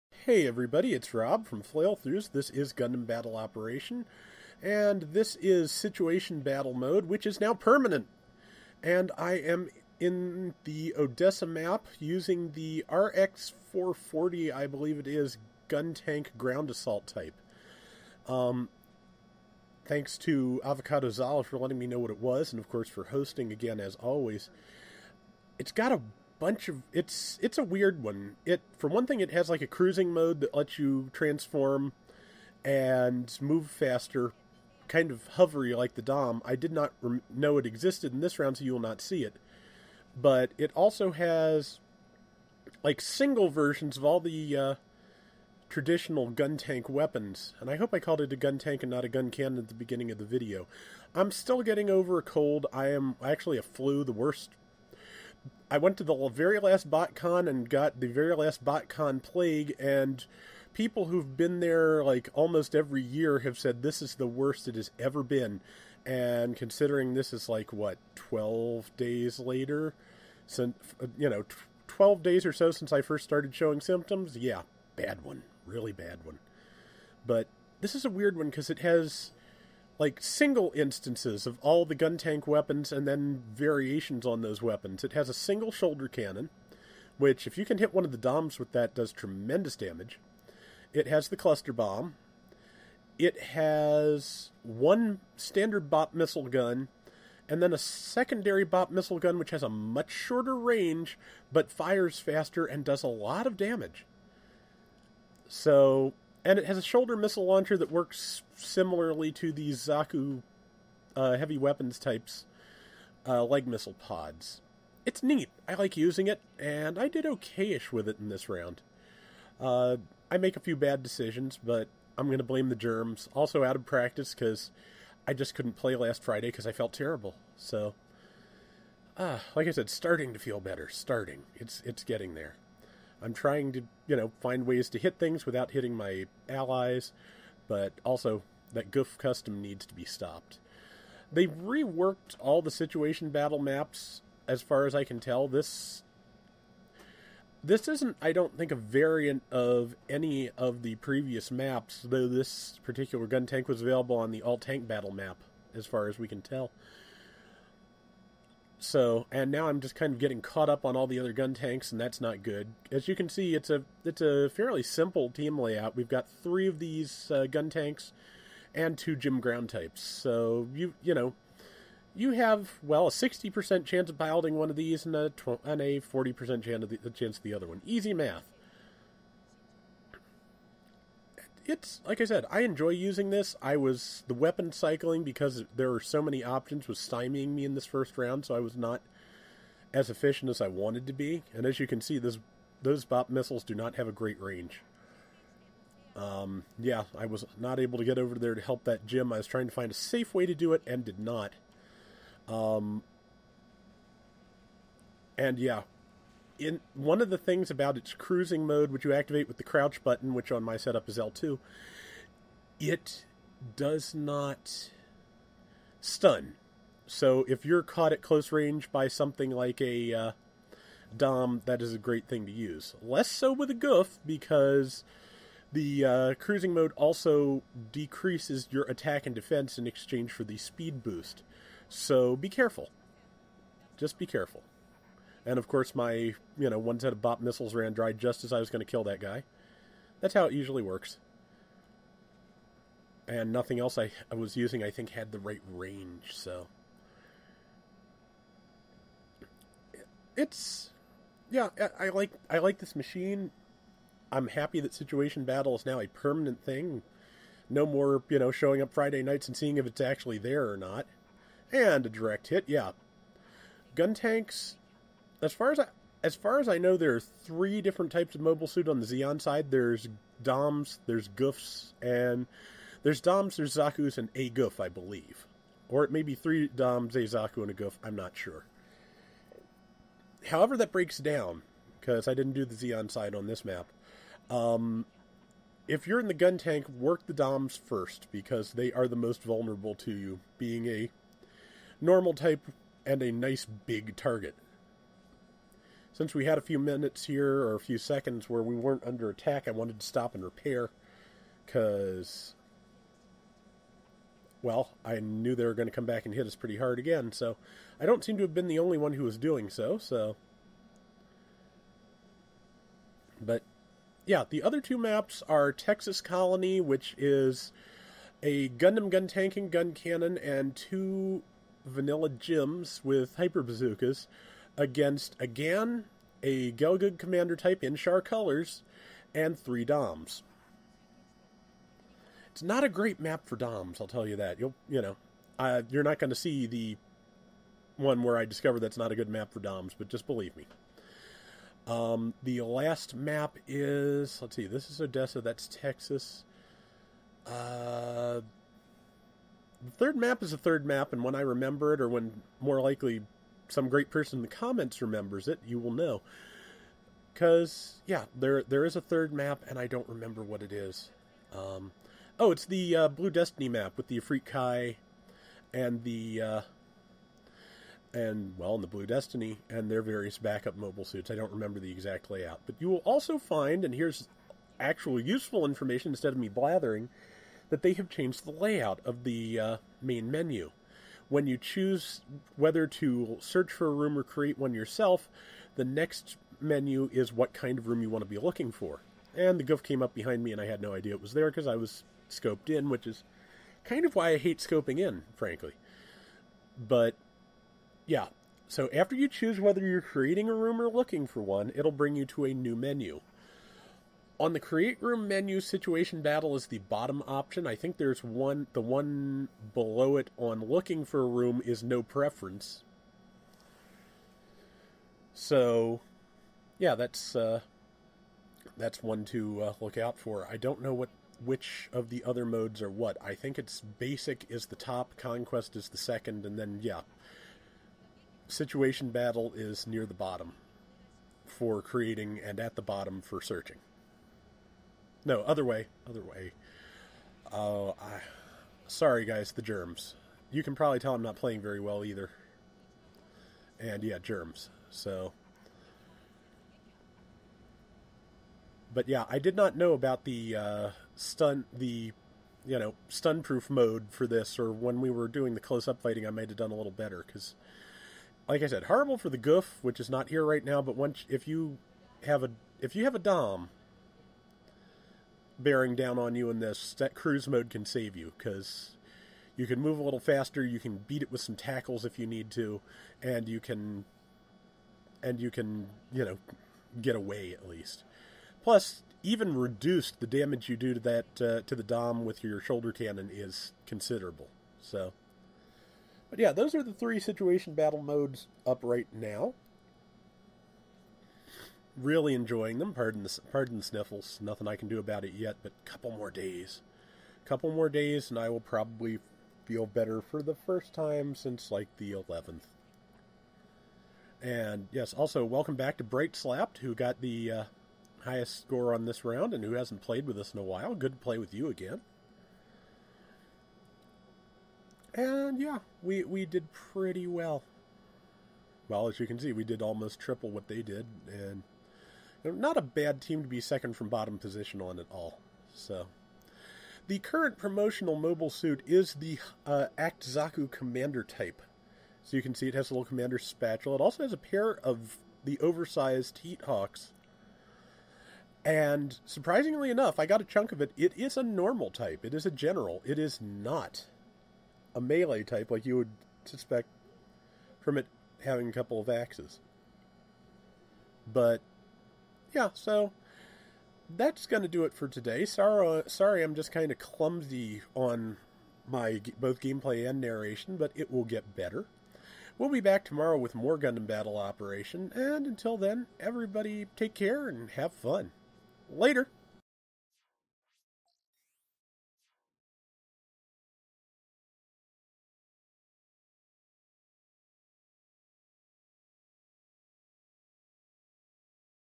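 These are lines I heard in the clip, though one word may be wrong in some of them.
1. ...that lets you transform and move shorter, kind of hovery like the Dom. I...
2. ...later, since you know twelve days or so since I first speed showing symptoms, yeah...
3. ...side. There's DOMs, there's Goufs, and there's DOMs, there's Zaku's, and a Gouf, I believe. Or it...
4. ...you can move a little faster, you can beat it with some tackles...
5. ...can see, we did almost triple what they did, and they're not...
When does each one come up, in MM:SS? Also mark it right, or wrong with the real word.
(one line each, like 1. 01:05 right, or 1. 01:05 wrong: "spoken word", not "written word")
1. 00:30 wrong: "faster", not "shorter"
2. 01:09 wrong: "started", not "speed"
3. 04:29 right
4. 07:49 right
5. 08:39 right.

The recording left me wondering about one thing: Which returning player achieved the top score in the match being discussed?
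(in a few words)
Bright Slapped.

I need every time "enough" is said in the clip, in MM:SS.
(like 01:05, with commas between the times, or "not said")
08:59.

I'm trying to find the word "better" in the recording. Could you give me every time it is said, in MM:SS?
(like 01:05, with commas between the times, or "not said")
02:10, 07:36, 08:19, 09:21.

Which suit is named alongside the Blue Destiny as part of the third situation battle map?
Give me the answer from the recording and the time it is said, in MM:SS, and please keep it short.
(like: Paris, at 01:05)
Efreet Kai, at 06:04.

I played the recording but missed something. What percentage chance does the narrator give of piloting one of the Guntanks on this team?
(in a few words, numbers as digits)
60 percent.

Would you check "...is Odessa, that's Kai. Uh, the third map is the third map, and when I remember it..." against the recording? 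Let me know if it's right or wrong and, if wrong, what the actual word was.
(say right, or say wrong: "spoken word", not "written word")
wrong: "Texas", not "Kai".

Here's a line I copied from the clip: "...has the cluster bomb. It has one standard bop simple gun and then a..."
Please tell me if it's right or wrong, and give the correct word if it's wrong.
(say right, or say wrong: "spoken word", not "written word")
wrong: "missile", not "simple".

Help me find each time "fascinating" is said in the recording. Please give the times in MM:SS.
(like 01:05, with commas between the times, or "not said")
not said.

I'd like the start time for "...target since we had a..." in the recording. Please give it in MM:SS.
04:54.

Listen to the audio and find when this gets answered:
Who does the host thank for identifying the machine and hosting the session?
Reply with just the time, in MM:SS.
00:20.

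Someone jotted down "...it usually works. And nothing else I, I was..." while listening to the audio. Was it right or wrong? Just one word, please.
right.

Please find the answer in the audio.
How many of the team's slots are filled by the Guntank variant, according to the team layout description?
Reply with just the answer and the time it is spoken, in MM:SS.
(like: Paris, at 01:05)
3, at 02:46.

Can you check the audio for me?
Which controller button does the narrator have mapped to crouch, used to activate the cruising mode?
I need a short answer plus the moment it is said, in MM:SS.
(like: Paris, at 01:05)
L2, at 03:31.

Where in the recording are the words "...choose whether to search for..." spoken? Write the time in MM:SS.
06:21.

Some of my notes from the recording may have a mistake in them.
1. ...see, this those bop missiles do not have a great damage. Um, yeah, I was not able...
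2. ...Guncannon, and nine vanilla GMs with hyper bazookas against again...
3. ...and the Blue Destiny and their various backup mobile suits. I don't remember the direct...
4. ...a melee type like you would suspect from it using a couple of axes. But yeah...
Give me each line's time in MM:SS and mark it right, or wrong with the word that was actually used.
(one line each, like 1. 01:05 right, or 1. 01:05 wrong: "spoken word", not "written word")
1. 03:12 wrong: "range", not "damage"
2. 05:19 wrong: "two", not "nine"
3. 06:08 wrong: "exact", not "direct"
4. 09:04 wrong: "having", not "using".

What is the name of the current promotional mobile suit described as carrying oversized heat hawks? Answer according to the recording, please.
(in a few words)
Act Zaku Commander type.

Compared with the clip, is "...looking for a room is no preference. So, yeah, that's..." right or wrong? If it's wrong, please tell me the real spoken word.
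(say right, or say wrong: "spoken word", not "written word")
right.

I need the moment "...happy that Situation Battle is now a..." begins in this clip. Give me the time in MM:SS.
04:14.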